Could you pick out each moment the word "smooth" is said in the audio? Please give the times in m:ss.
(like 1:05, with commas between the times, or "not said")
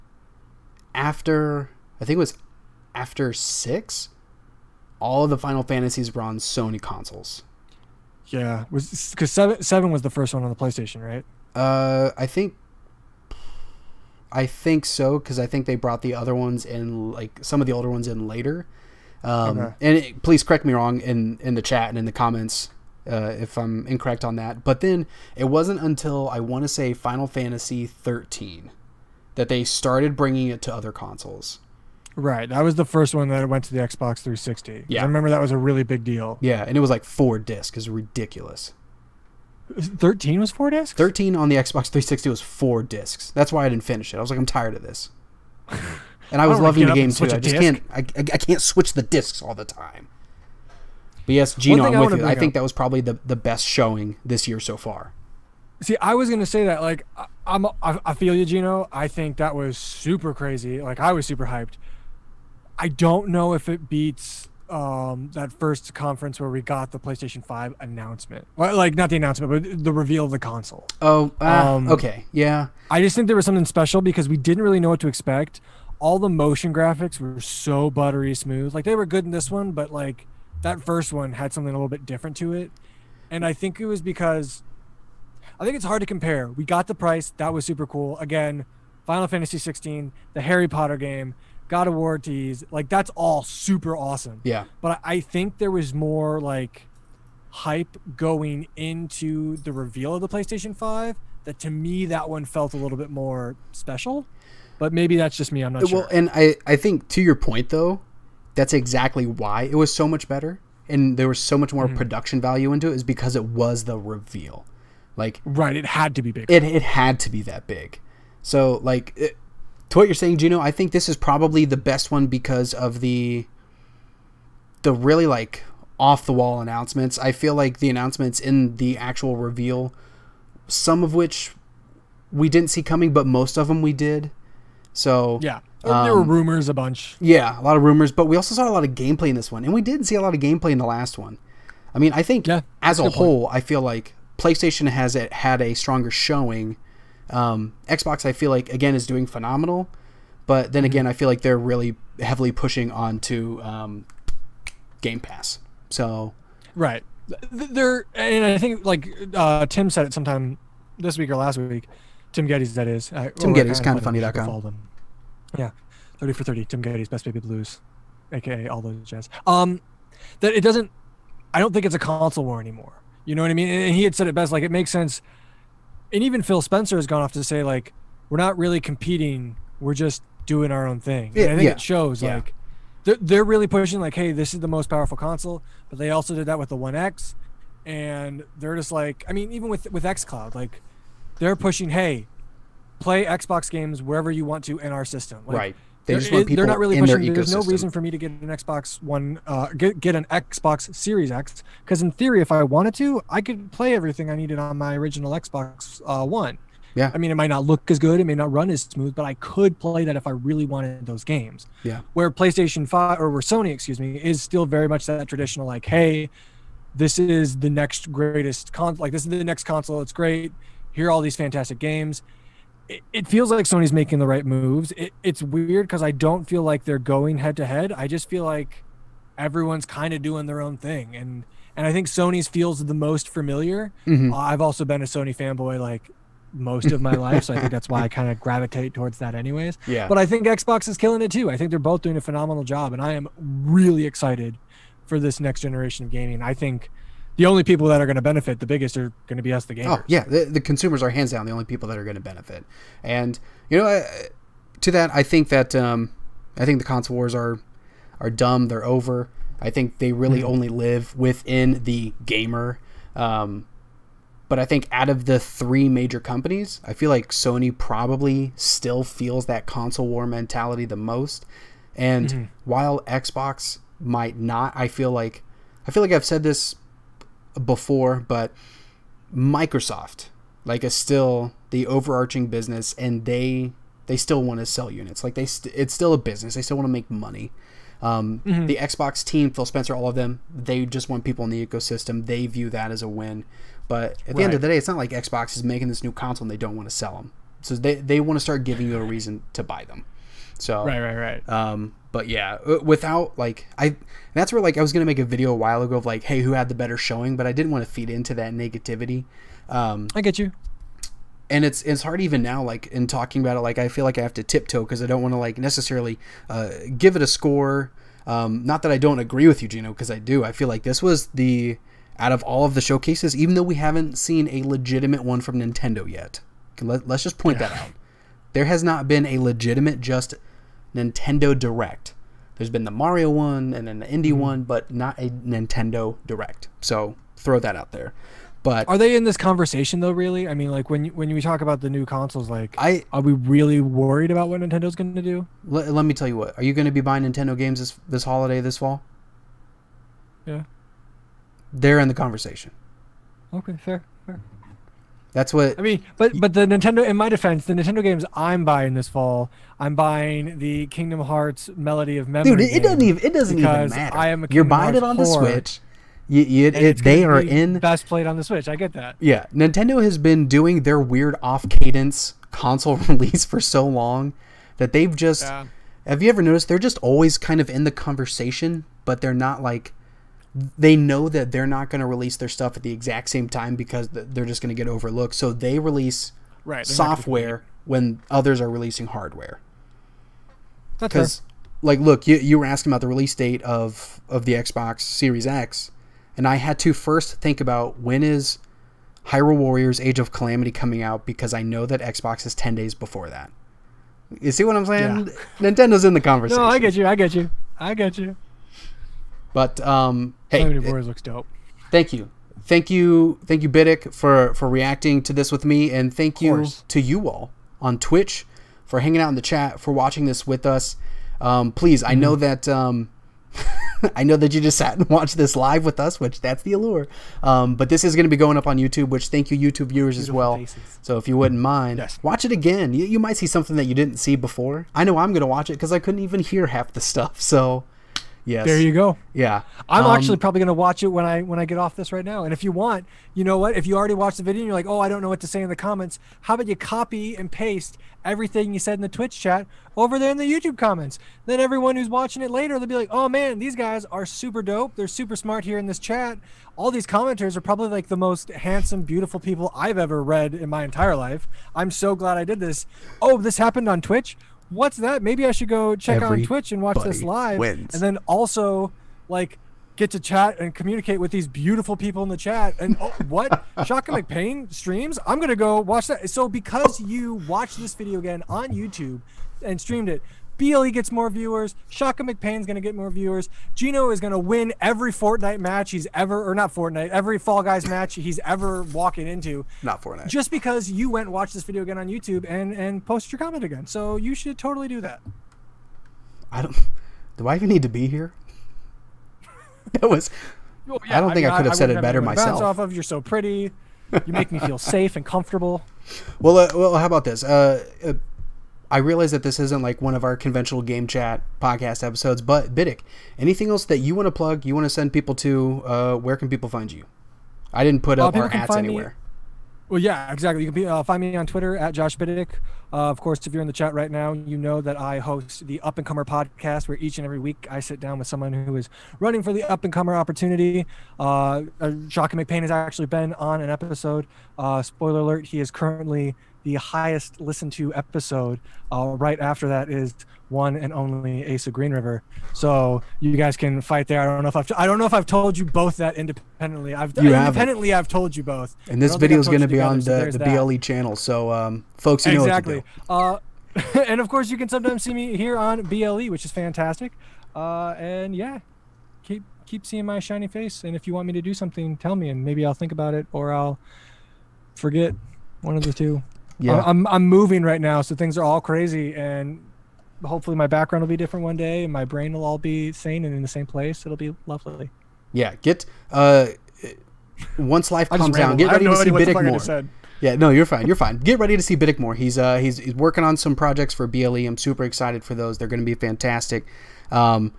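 1:18, 3:28.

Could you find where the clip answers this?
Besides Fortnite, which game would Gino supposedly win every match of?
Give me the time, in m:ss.
8:07.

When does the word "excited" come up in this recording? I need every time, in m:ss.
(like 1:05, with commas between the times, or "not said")
4:04, 9:44.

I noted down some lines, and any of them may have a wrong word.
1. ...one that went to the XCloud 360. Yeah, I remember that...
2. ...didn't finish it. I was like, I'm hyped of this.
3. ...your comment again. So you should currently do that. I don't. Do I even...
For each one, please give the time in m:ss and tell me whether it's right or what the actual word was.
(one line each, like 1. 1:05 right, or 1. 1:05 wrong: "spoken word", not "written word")
1. 0:33 wrong: "Xbox", not "XCloud"
2. 0:43 wrong: "tired", not "hyped"
3. 8:13 wrong: "totally", not "currently".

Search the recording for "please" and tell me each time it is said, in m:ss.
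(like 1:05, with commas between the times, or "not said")
0:20, 7:01.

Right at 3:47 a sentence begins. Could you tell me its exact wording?
I just feel like everyone's kind of doing their own thing, and and I think Sony's feels the most familiar.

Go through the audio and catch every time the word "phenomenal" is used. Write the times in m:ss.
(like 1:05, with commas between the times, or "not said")
2:29, 4:02.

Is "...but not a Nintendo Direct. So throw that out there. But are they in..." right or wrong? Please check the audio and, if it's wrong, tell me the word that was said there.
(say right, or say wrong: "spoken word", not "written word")
right.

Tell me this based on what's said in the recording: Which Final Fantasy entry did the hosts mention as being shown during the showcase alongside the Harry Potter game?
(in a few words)
Final Fantasy 16.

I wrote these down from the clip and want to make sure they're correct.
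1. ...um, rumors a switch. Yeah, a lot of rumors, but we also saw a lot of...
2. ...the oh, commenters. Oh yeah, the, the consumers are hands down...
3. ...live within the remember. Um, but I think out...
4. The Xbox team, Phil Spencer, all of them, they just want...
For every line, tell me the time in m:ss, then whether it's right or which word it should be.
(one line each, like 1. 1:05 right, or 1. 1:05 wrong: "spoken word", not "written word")
1. 2:16 wrong: "bunch", not "switch"
2. 4:09 wrong: "gamers", not "commenters"
3. 4:20 wrong: "gamer", not "remember"
4. 4:48 right.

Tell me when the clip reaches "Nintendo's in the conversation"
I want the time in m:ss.
6:45.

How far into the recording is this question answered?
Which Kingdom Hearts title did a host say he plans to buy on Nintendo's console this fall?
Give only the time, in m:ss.
6:00.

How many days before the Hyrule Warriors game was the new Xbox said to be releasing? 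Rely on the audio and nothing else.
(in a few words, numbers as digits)
10.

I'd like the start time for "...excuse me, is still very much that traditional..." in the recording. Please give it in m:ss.
3:33.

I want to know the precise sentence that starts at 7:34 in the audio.
They're super smart here in this chat.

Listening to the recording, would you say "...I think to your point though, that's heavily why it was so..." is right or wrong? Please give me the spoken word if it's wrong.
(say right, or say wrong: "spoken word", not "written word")
wrong: "exactly", not "heavily".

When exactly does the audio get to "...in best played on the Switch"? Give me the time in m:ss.
6:07.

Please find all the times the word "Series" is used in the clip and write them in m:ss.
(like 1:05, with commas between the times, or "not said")
3:20, 6:35.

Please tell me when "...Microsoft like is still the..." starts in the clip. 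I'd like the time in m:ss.
4:39.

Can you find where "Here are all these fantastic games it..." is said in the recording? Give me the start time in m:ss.
3:40.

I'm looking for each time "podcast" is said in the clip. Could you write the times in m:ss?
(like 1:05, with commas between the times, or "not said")
8:31, 8:46.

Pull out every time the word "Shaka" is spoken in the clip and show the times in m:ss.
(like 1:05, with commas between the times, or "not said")
7:53, 8:01, 8:52.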